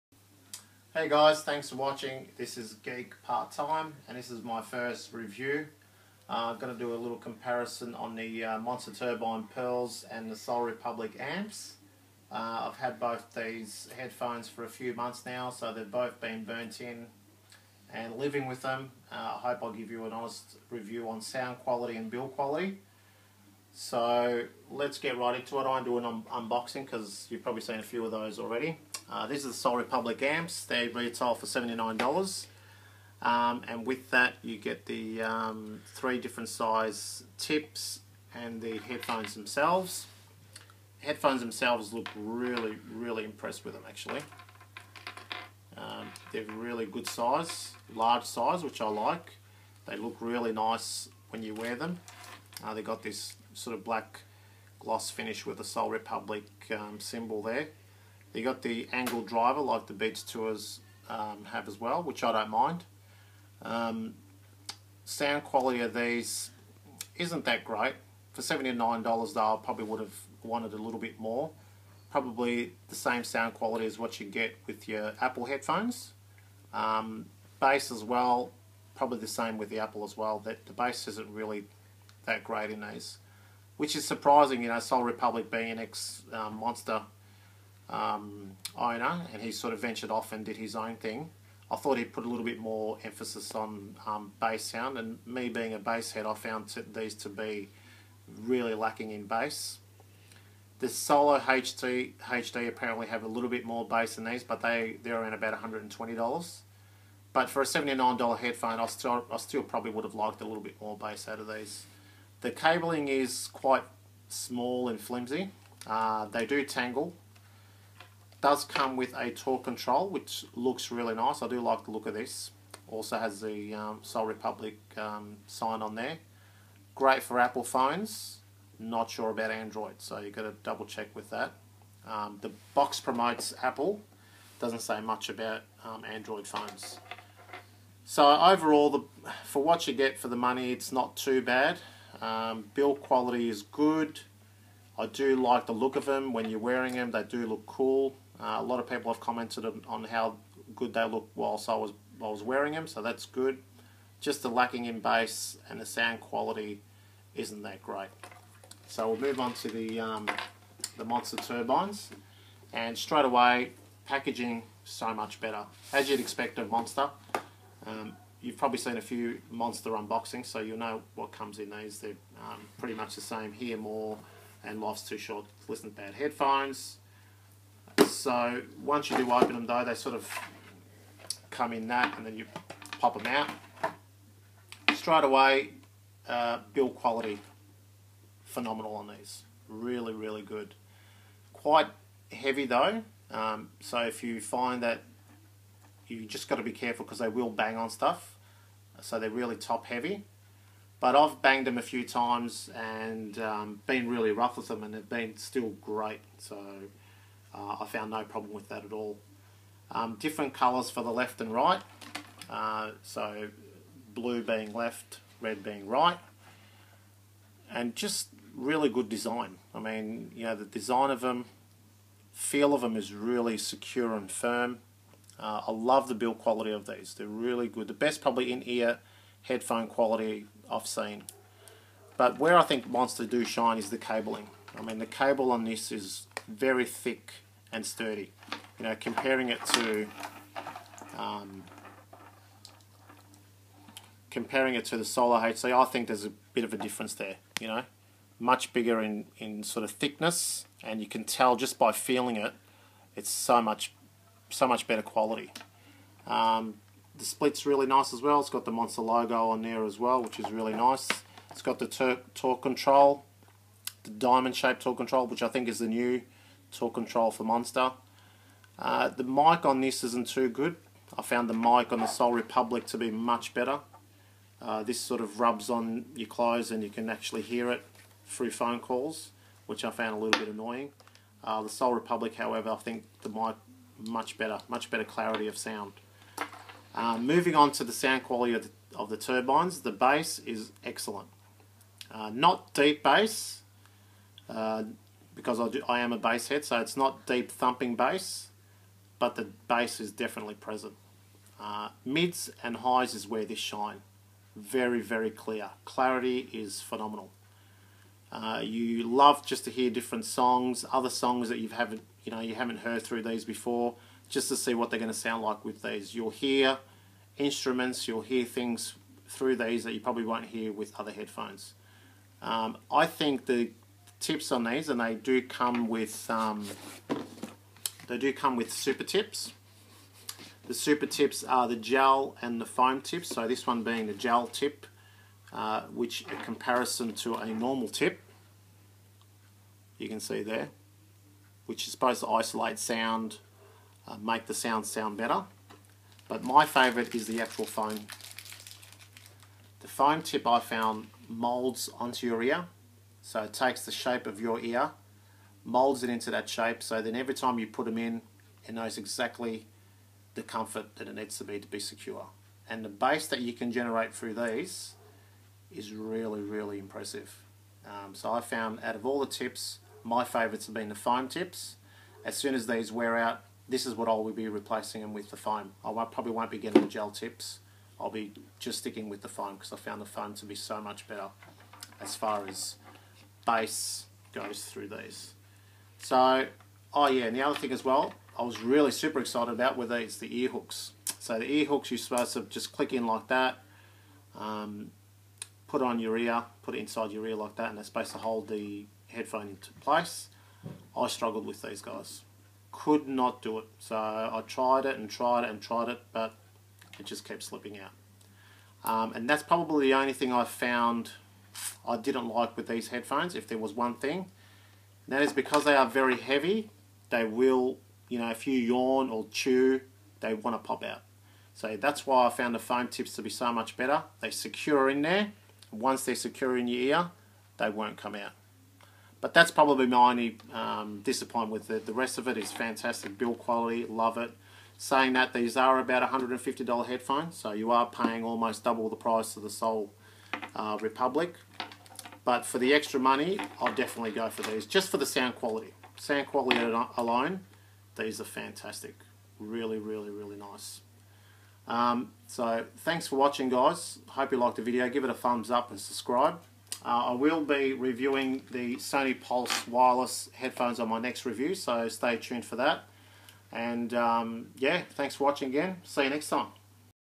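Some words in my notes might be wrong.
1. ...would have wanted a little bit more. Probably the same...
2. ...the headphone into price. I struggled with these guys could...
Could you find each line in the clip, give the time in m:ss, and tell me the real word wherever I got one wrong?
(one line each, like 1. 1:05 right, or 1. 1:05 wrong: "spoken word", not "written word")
1. 1:09 right
2. 6:38 wrong: "place", not "price".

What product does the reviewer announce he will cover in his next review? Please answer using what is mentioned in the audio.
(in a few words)
Sony Pulse wireless headphones.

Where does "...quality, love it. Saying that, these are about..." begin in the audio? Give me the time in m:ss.
7:13.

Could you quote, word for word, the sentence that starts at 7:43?
And um, yeah, thanks for watching again.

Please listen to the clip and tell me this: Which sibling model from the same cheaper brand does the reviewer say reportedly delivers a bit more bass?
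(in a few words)
Solo HD.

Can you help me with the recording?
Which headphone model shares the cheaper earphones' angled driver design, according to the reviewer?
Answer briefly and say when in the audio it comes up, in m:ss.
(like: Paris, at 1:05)
Beats Tours, at 0:59.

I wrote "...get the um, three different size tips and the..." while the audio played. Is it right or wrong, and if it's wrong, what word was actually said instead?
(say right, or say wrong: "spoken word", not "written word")
right.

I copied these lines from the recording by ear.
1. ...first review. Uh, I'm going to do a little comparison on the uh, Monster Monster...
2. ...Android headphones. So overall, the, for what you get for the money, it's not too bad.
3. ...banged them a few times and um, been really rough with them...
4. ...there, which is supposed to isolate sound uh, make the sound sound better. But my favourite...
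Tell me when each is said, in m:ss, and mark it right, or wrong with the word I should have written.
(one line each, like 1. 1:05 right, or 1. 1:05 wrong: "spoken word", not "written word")
1. 0:04 wrong: "Turbine", not "Monster"
2. 2:16 wrong: "phones", not "headphones"
3. 3:21 right
4. 5:40 right.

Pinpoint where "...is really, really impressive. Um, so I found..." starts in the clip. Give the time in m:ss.
6:05.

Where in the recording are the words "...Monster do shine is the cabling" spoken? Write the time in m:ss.
3:52.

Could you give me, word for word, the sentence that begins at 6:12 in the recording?
As soon as these wear out, this is what I will be replacing them with the foam.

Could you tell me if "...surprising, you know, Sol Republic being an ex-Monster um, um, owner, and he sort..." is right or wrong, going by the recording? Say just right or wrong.
right.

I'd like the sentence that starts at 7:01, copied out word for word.
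So that's why I found the foam tips to be so much better.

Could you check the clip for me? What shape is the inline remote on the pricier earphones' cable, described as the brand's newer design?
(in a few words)
Diamond.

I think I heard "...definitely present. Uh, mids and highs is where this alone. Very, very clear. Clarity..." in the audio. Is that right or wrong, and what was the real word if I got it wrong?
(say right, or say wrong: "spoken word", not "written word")
wrong: "shine", not "alone".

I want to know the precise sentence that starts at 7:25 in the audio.
Sound quality alone, these are fantastic.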